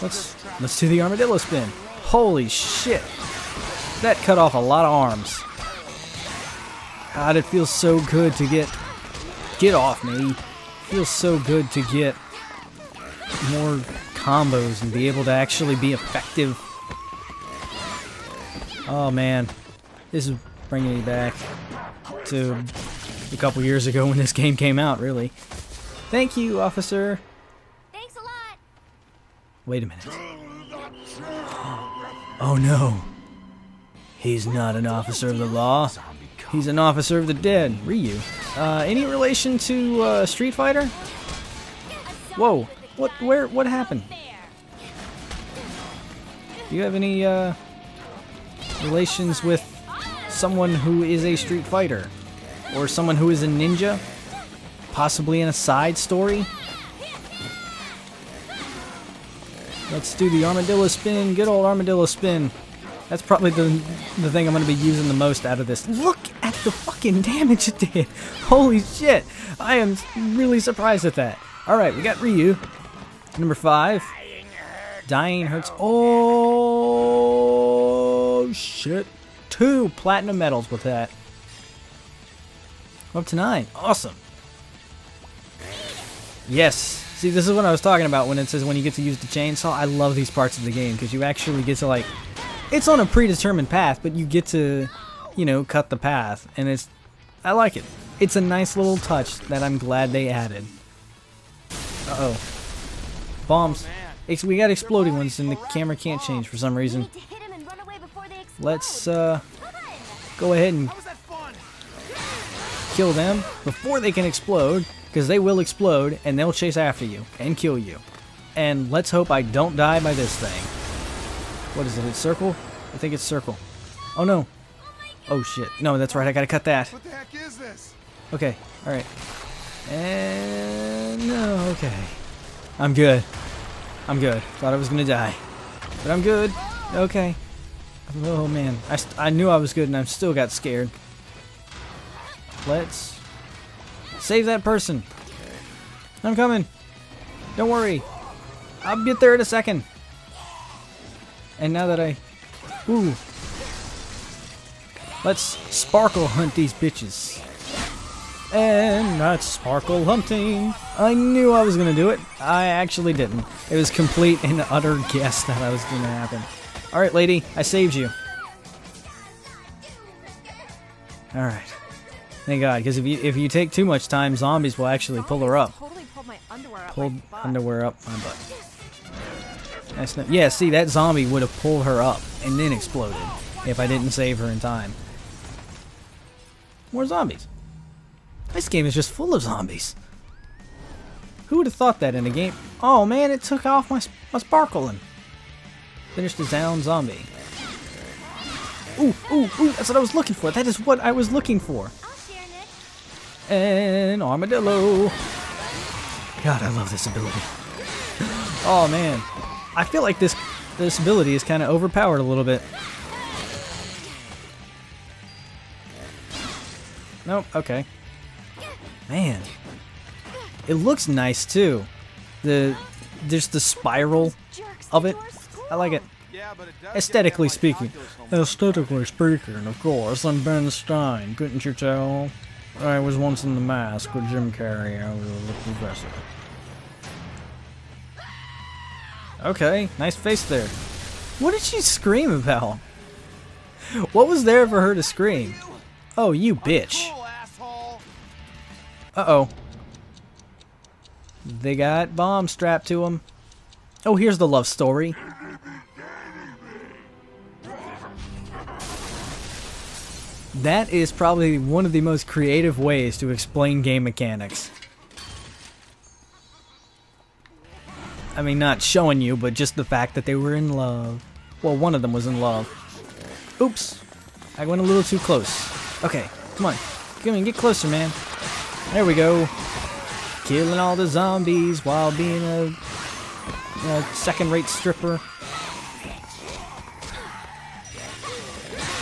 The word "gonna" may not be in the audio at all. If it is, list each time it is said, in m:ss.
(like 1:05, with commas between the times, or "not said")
2:14.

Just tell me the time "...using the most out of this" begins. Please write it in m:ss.
1:04.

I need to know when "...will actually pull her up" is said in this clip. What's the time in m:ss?
2:54.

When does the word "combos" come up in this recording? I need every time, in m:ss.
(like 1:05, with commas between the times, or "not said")
0:14.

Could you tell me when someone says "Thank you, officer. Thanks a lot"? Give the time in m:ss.
0:26.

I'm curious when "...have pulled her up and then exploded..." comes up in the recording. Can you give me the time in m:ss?
3:01.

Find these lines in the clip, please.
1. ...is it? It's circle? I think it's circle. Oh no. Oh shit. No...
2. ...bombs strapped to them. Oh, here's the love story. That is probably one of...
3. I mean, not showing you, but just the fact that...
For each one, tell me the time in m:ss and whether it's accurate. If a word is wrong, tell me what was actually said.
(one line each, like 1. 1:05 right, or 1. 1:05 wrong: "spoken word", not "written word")
1. 2:01 right
2. 4:12 right
3. 4:28 right.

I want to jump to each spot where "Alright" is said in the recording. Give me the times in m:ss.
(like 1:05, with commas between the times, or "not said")
1:11.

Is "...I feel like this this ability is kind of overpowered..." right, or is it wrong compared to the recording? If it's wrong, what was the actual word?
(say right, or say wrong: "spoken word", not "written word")
right.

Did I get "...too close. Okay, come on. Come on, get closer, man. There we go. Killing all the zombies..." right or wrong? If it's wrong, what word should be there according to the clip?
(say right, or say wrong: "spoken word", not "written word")
right.